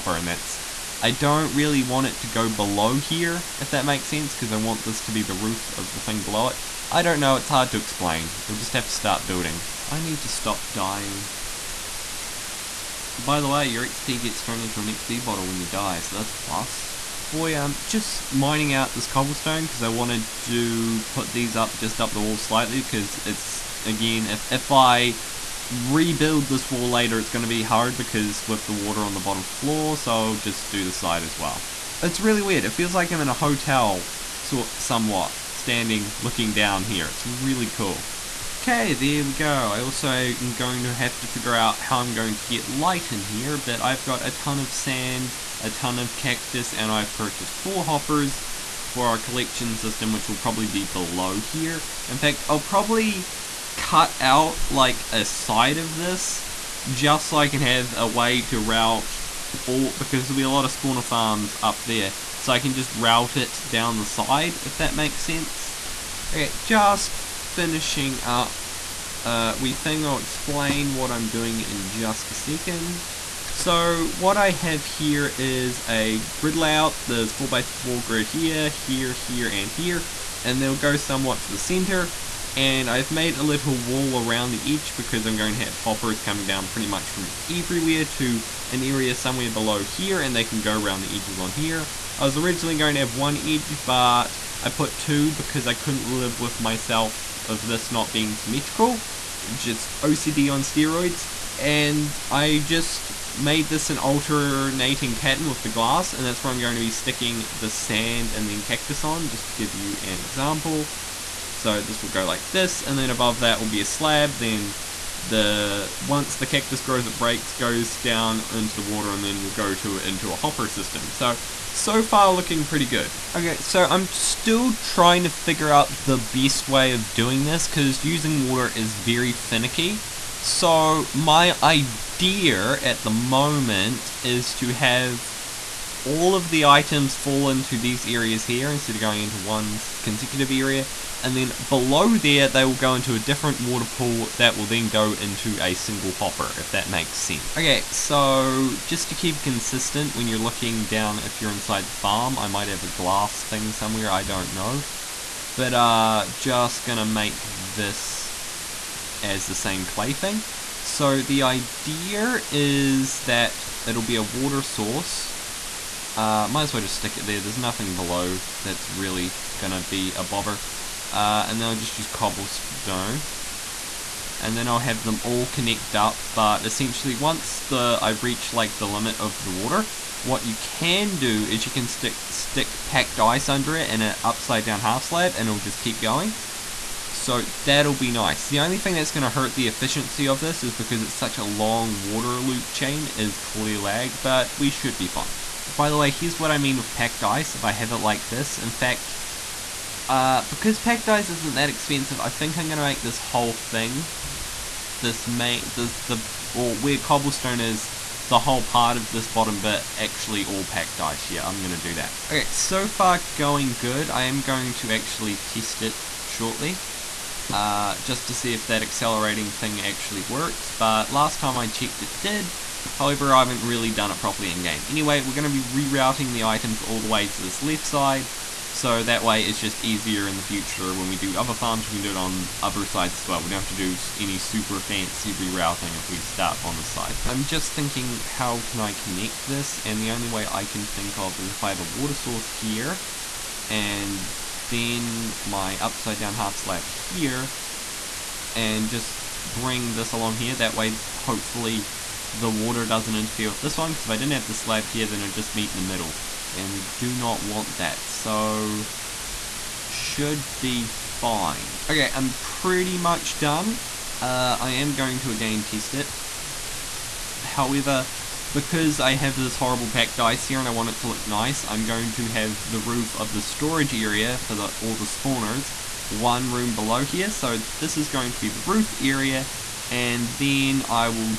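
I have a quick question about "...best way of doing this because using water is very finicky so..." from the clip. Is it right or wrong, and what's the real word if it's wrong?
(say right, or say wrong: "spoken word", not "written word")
right.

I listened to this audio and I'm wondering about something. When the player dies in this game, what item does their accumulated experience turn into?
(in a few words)
XP bottle.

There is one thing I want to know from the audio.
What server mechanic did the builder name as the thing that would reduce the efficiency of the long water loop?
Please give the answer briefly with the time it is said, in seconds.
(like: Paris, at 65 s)
Clear lag, at 193 s.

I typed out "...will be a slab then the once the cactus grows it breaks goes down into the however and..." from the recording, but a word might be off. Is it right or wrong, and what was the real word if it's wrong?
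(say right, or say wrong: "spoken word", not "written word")
wrong: "water", not "however".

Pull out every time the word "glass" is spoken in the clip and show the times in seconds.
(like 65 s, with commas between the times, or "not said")
105 s, 152 s.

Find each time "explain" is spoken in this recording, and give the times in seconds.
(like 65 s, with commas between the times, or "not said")
7 s, 70 s.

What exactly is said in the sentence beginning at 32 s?
It's really weird, it feels like I'm in a hotel sort somewhat standing looking down here, it's really cool.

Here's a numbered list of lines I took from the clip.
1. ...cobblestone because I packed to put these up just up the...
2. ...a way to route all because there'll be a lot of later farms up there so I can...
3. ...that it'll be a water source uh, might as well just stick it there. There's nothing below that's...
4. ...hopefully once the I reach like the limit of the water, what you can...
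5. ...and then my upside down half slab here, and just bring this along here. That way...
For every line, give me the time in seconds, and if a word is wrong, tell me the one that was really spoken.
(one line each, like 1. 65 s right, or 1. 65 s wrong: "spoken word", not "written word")
1. 19 s wrong: "wanted", not "packed"
2. 57 s wrong: "spawner", not "later"
3. 163 s right
4. 176 s wrong: "essentially", not "hopefully"
5. 243 s right.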